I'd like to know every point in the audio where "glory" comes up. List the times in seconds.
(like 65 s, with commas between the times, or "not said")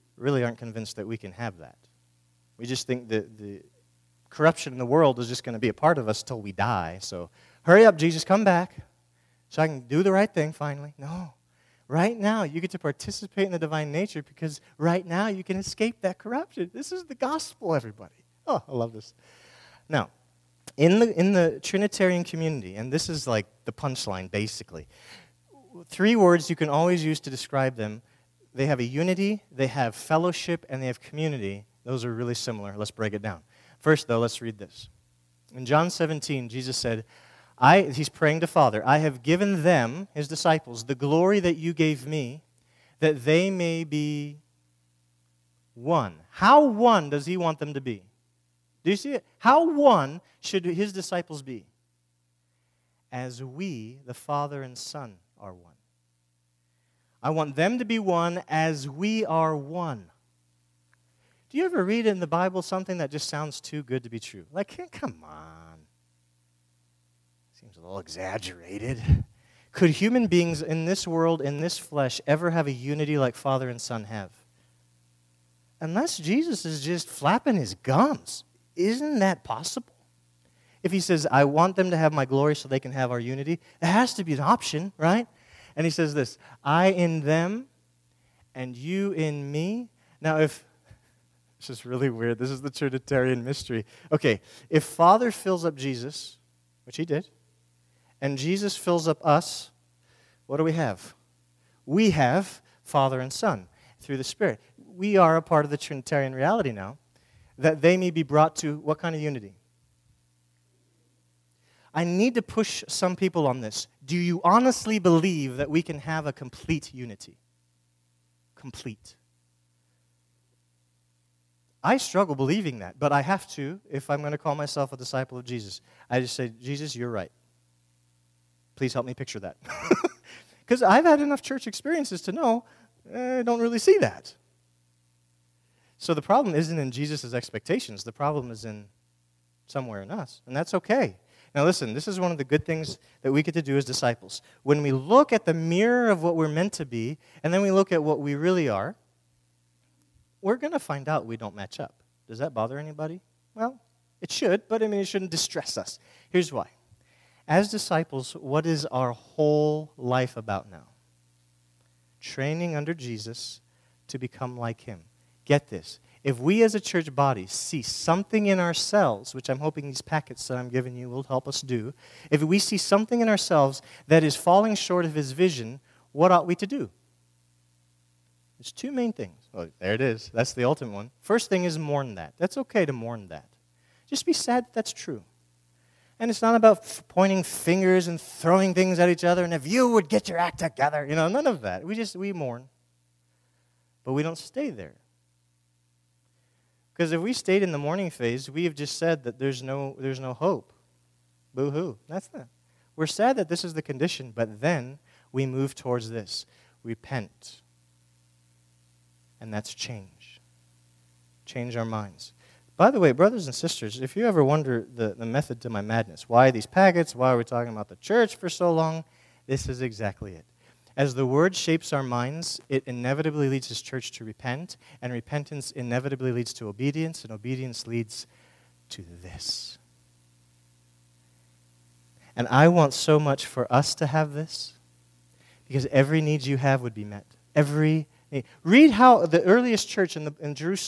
40 s, 82 s.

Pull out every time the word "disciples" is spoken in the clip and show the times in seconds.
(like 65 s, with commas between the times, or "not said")
40 s, 50 s, 124 s, 143 s, 157 s.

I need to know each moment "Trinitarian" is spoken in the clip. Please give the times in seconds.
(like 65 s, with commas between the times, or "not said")
21 s, 92 s, 105 s.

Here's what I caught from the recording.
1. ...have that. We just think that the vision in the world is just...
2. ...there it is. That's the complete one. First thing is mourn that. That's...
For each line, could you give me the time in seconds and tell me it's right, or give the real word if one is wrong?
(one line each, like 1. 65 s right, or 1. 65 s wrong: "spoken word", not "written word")
1. 1 s wrong: "corruption", not "vision"
2. 179 s wrong: "ultimate", not "complete".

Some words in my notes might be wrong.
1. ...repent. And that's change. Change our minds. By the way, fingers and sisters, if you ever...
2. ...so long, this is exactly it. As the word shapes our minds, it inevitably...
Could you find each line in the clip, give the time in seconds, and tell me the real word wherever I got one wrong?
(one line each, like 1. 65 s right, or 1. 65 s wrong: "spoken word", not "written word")
1. 206 s wrong: "brothers", not "fingers"
2. 218 s right.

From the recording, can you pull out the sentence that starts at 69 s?
Could human beings in this world, in this flesh, ever have a unity like Father and Son have?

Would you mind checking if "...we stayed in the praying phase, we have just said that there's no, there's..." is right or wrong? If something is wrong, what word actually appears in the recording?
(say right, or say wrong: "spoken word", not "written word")
wrong: "mourning", not "praying".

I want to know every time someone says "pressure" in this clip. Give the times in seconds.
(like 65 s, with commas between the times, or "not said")
not said.